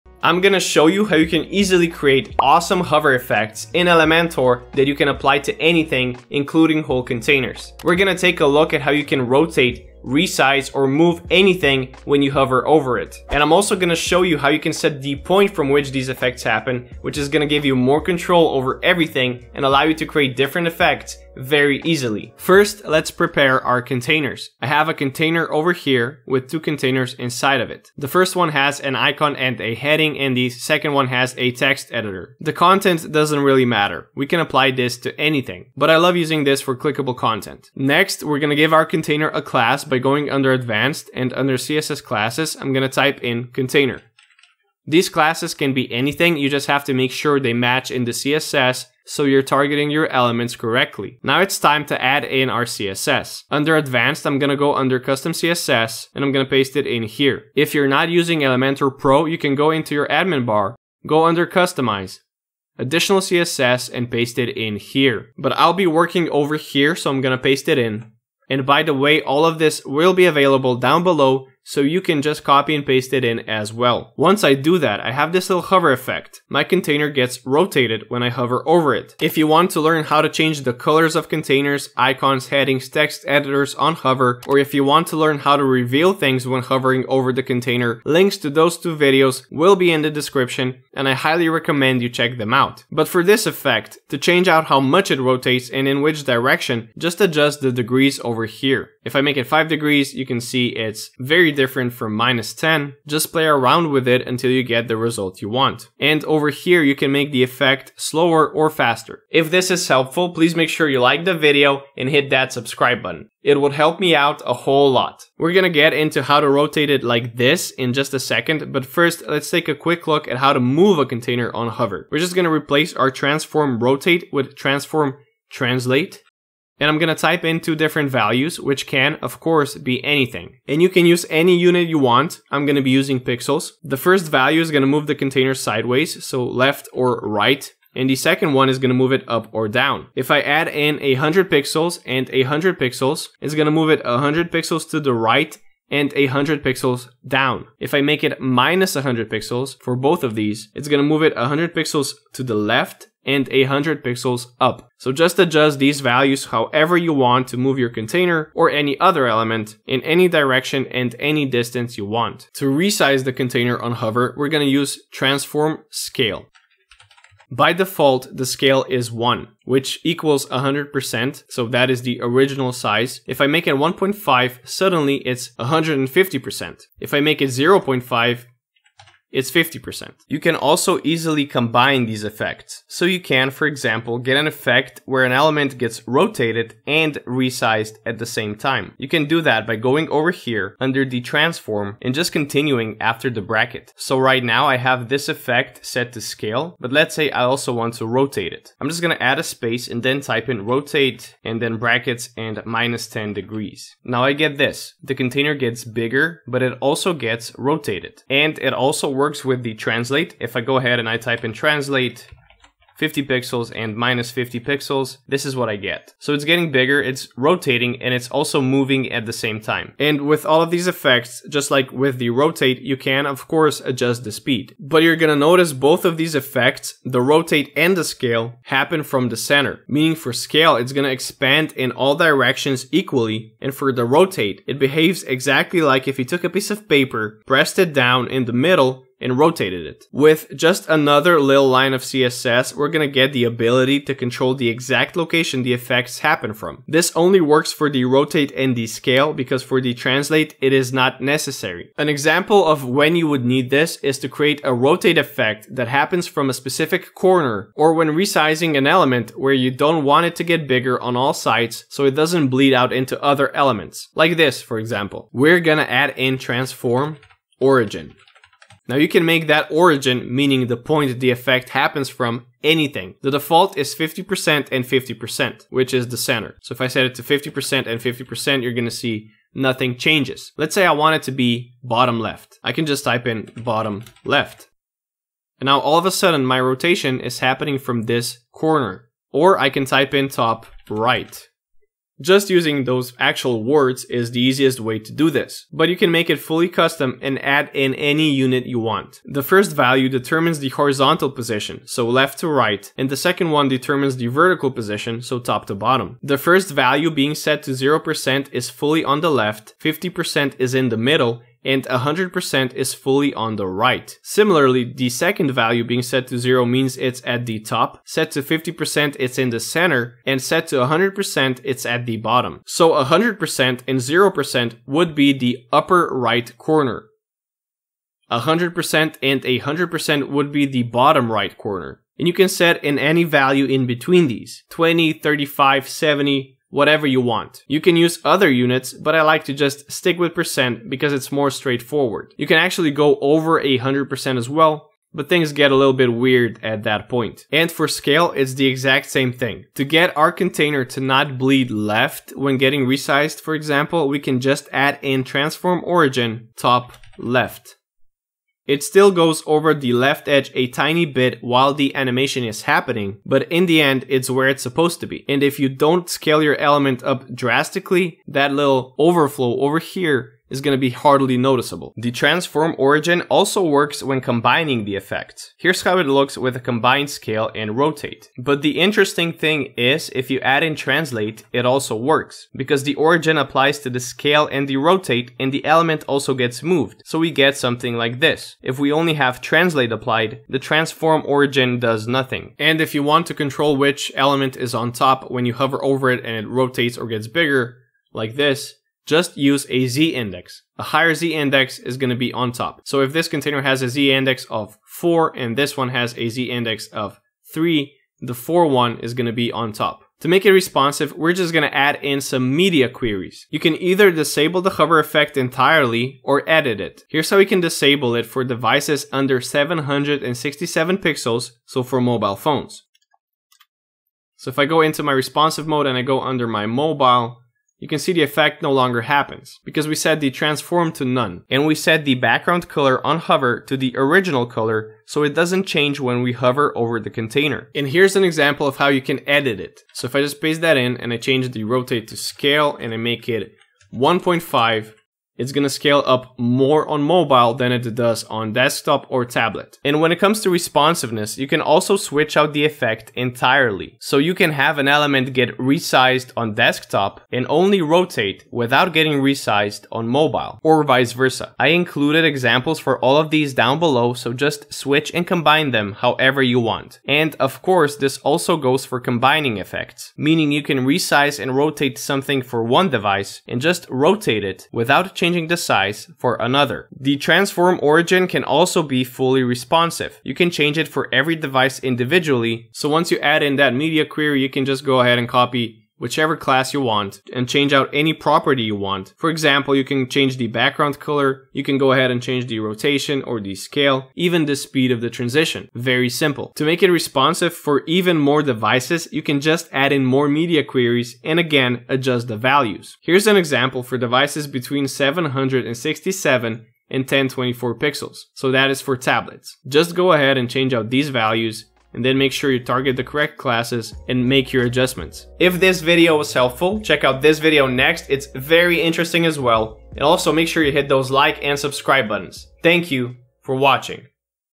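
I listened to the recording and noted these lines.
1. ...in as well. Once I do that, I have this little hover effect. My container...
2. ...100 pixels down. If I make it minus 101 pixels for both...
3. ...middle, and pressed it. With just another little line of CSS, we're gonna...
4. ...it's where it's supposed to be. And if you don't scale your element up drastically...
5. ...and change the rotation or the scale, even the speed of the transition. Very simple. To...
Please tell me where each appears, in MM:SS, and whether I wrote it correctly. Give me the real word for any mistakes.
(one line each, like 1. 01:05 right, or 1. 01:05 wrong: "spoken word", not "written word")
1. 01:13 right
2. 02:26 wrong: "100", not "101"
3. 03:58 wrong: "rotated", not "pressed"
4. 06:04 right
5. 08:12 right.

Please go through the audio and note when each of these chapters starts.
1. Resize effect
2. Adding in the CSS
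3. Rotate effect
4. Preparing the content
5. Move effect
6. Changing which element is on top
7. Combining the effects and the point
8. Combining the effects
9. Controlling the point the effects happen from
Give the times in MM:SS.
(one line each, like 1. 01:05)
1. 02:42
2. 00:51
3. 01:32
4. 00:22
5. 02:02
6. 06:32
7. 06:11
8. 03:00
9. 03:44.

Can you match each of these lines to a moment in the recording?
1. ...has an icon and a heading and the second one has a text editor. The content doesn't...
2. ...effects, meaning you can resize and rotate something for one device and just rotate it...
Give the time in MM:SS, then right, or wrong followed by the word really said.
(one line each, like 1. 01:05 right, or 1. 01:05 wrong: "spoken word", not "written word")
1. 00:28 right
2. 07:49 right.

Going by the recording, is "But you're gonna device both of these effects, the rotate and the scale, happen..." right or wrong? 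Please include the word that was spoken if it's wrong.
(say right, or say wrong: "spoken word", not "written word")
wrong: "notice", not "device".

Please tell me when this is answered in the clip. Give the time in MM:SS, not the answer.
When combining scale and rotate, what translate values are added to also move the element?
03:32.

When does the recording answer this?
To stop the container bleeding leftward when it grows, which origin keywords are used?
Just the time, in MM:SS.
05:55.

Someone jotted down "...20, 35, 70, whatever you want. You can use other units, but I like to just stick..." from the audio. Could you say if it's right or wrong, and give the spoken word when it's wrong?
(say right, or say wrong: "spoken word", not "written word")
right.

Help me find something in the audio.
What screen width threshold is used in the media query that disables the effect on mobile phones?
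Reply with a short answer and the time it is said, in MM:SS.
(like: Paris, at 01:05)
767 pixels, at 06:59.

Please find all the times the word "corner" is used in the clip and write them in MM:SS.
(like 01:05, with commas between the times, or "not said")
04:17, 04:48, 05:26, 05:31.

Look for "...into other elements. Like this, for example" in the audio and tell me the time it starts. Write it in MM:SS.
04:22.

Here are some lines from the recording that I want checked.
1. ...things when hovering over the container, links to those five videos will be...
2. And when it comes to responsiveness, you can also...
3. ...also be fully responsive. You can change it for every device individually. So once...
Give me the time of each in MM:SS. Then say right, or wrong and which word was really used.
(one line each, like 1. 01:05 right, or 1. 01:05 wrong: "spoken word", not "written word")
1. 01:26 wrong: "two", not "five"
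2. 07:29 right
3. 07:58 right.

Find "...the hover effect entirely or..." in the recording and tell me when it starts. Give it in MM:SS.
06:54.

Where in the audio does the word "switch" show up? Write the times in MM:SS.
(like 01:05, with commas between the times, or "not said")
07:31, 07:44.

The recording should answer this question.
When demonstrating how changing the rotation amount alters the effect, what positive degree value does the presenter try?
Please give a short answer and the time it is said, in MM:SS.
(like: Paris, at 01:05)
5 degrees, at 01:39.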